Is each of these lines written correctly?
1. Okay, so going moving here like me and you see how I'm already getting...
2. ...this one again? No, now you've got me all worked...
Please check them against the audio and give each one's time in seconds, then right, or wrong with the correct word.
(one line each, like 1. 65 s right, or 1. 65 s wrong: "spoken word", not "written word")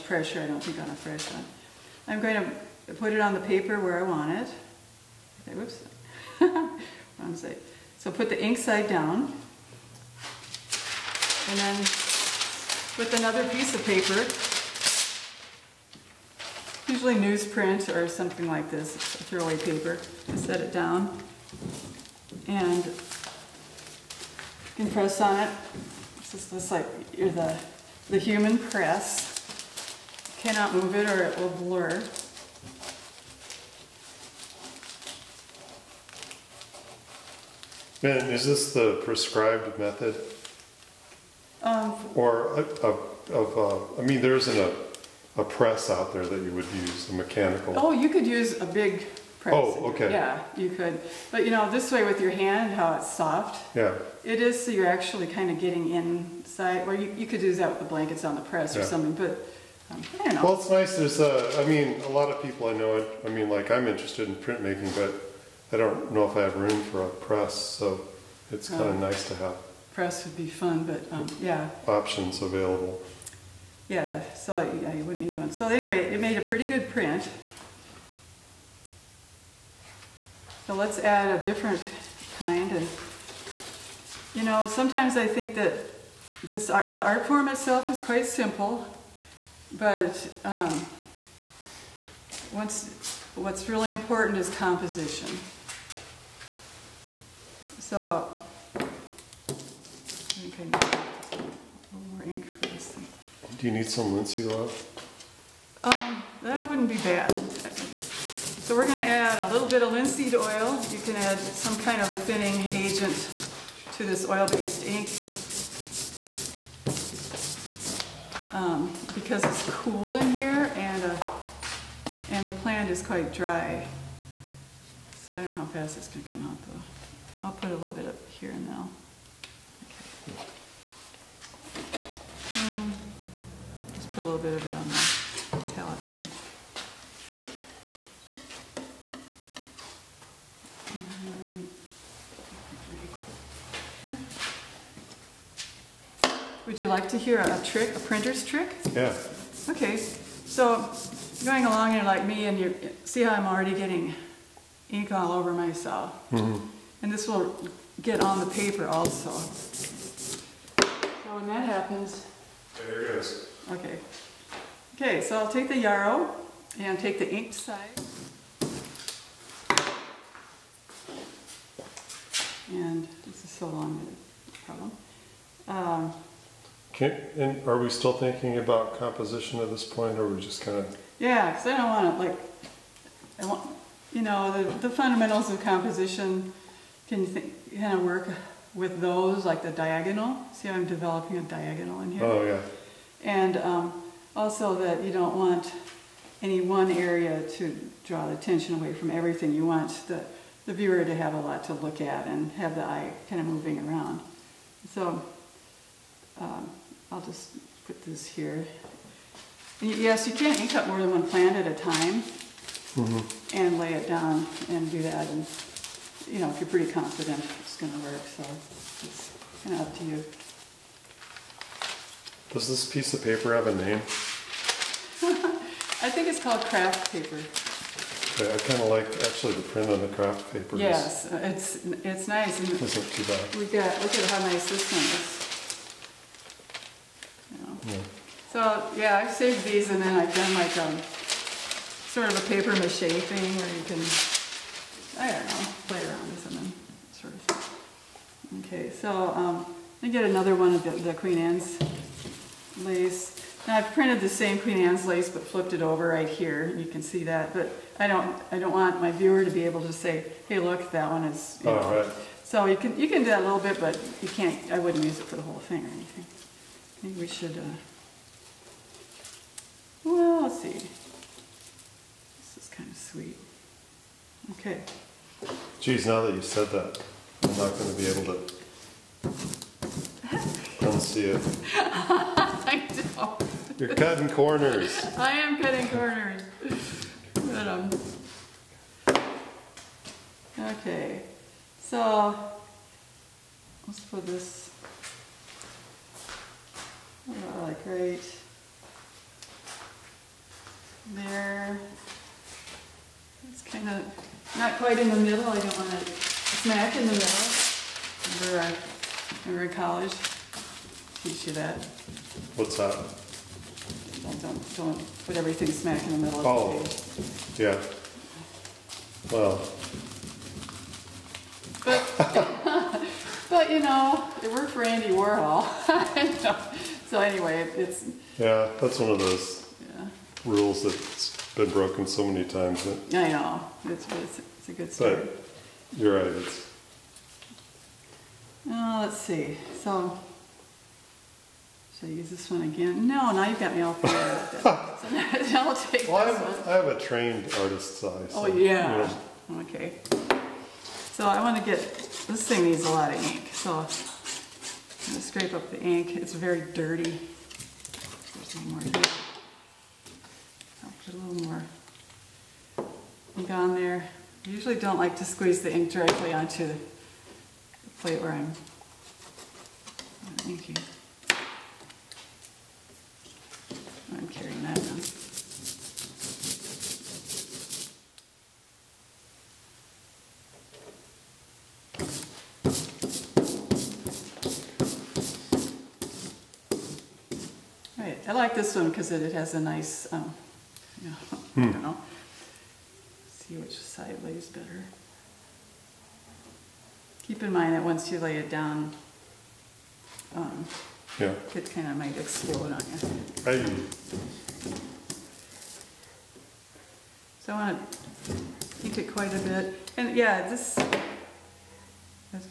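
1. 149 s wrong: "along", not "moving"
2. 342 s wrong: "fired", not "worked".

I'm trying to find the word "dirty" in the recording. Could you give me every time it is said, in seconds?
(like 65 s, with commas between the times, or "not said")
356 s.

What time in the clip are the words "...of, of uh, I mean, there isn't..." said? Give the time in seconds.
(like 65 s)
42 s.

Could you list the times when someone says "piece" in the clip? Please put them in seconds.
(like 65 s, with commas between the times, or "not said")
13 s, 222 s.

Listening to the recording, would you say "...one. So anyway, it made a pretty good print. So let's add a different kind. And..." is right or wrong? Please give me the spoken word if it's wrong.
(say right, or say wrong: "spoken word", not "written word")
right.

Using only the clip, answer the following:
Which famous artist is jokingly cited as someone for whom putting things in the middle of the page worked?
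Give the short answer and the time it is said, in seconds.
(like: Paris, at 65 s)
Andy Warhol, at 324 s.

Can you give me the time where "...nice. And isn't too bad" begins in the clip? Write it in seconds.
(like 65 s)
232 s.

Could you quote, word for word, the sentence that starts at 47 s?
Oh, you could use a big press.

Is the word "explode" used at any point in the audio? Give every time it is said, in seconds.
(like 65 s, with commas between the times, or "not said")
402 s.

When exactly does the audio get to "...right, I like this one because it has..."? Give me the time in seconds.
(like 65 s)
388 s.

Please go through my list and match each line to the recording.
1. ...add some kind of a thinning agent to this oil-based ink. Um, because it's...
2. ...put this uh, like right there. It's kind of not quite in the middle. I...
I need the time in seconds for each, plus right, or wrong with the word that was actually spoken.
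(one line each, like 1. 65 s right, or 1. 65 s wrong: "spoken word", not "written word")
1. 111 s right
2. 294 s right.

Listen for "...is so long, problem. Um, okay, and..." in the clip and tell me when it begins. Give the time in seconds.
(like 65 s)
173 s.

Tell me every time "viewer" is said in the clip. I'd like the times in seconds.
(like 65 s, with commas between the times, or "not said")
200 s, 259 s.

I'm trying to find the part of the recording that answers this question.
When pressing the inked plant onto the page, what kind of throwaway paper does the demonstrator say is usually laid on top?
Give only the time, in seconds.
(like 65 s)
17 s.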